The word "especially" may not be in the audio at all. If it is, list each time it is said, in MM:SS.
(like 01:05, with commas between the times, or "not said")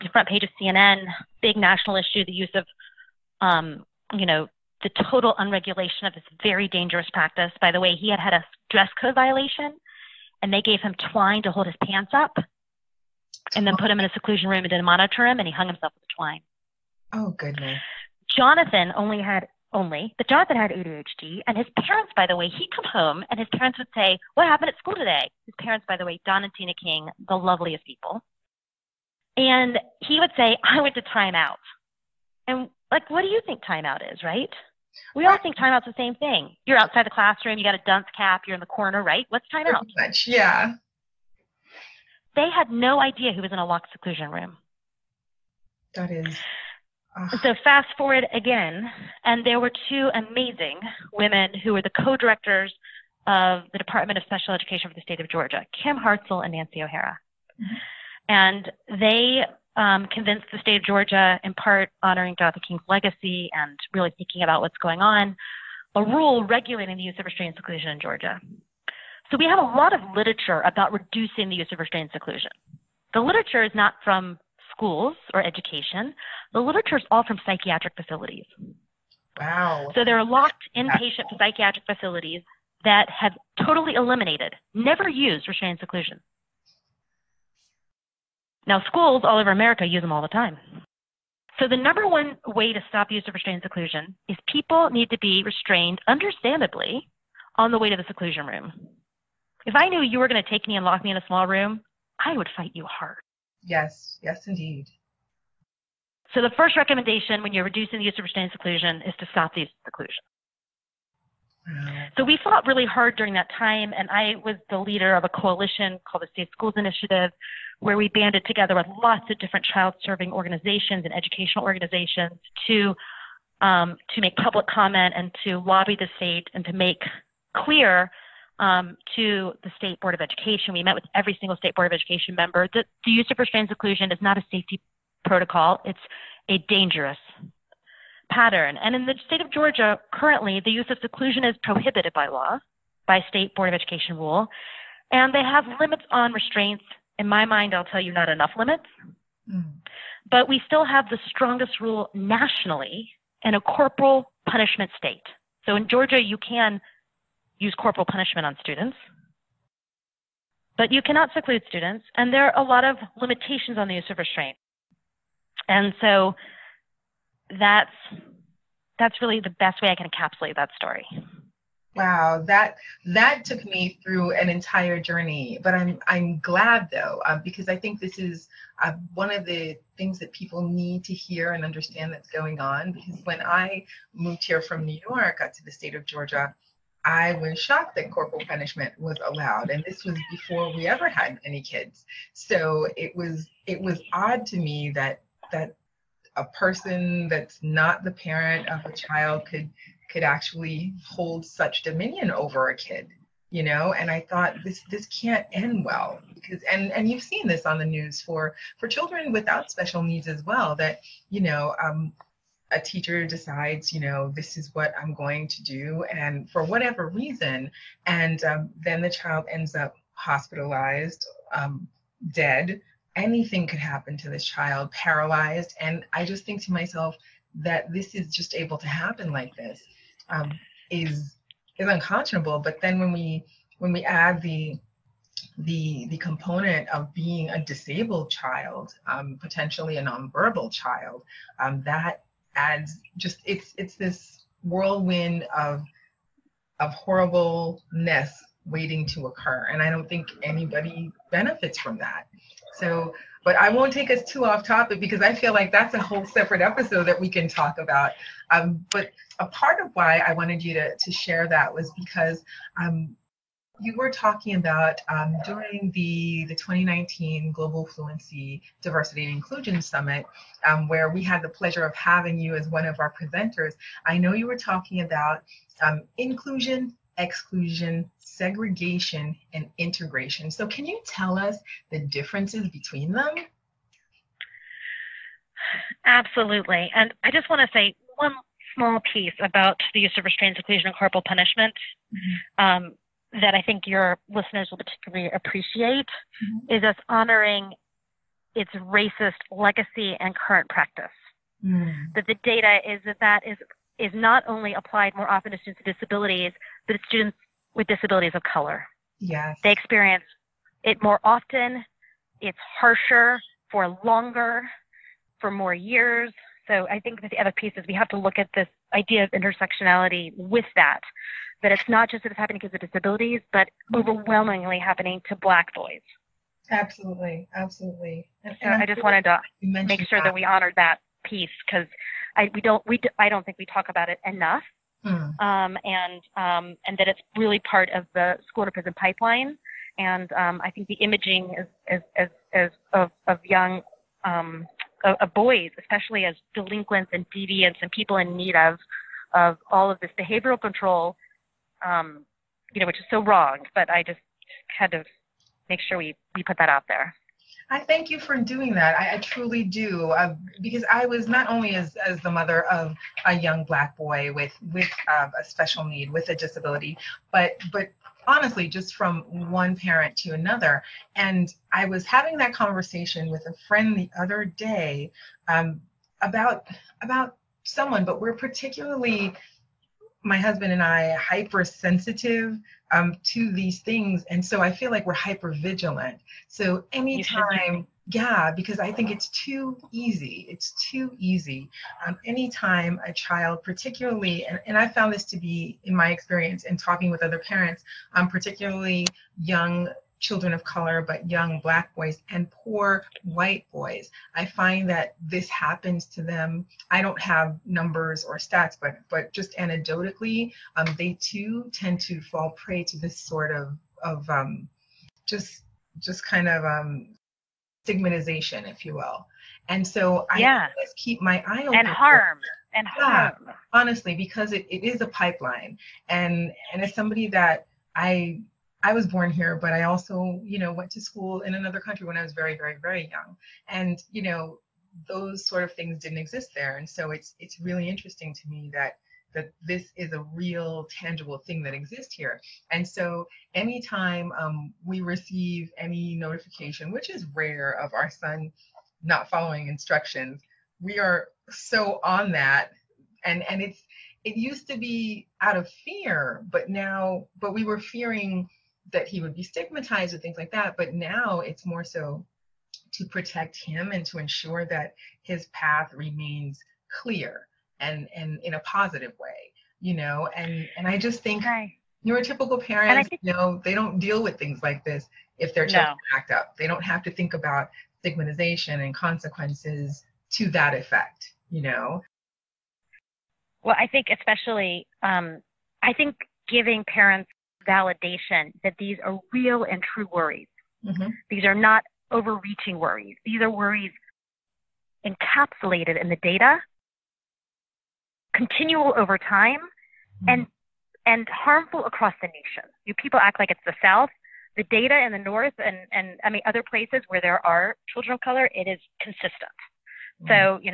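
05:45, 08:04.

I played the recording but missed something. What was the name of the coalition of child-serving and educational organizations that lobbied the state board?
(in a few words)
Safe Schools Initiative.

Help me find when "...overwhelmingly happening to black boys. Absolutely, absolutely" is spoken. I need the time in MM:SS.
05:23.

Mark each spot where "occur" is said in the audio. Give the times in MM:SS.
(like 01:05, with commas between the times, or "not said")
04:09.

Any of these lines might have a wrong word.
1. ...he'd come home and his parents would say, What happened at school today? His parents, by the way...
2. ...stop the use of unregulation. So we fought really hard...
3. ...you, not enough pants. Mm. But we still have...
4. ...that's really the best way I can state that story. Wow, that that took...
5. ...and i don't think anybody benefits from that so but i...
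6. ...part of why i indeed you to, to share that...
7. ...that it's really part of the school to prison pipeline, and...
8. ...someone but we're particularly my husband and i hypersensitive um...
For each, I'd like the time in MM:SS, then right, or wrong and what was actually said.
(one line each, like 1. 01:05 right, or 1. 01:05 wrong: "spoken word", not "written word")
1. 00:22 right
2. 01:49 wrong: "seclusion", not "unregulation"
3. 02:28 wrong: "limits", not "pants"
4. 02:48 wrong: "encapsulate", not "state"
5. 04:09 right
6. 04:19 wrong: "wanted", not "indeed"
7. 05:36 right
8. 06:17 right.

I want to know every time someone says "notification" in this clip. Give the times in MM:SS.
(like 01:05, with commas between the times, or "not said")
07:26.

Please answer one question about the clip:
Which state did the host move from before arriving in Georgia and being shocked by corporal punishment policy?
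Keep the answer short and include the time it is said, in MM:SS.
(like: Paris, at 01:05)
New York, at 03:04.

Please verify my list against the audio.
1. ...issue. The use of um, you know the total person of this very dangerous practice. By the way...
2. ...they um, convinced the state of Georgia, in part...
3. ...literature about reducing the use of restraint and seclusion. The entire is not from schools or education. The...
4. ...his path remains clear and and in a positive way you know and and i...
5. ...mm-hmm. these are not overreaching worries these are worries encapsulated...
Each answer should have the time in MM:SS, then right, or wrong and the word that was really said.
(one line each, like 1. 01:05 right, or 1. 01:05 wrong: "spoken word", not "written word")
1. 00:01 wrong: "unregulation", not "person"
2. 00:58 right
3. 01:10 wrong: "literature", not "entire"
4. 07:45 right
5. 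08:10 right.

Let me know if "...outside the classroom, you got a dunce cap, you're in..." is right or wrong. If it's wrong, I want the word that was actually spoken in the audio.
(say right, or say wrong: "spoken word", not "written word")
right.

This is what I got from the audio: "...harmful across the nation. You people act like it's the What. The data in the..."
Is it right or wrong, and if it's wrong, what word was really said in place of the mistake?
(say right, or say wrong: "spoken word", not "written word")
wrong: "South", not "What".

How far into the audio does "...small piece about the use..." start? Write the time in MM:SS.
04:48.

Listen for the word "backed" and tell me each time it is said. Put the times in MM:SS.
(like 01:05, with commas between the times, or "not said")
not said.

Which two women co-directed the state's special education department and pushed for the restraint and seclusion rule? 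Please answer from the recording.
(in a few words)
Kim Hartzell and Nancy O'Hara.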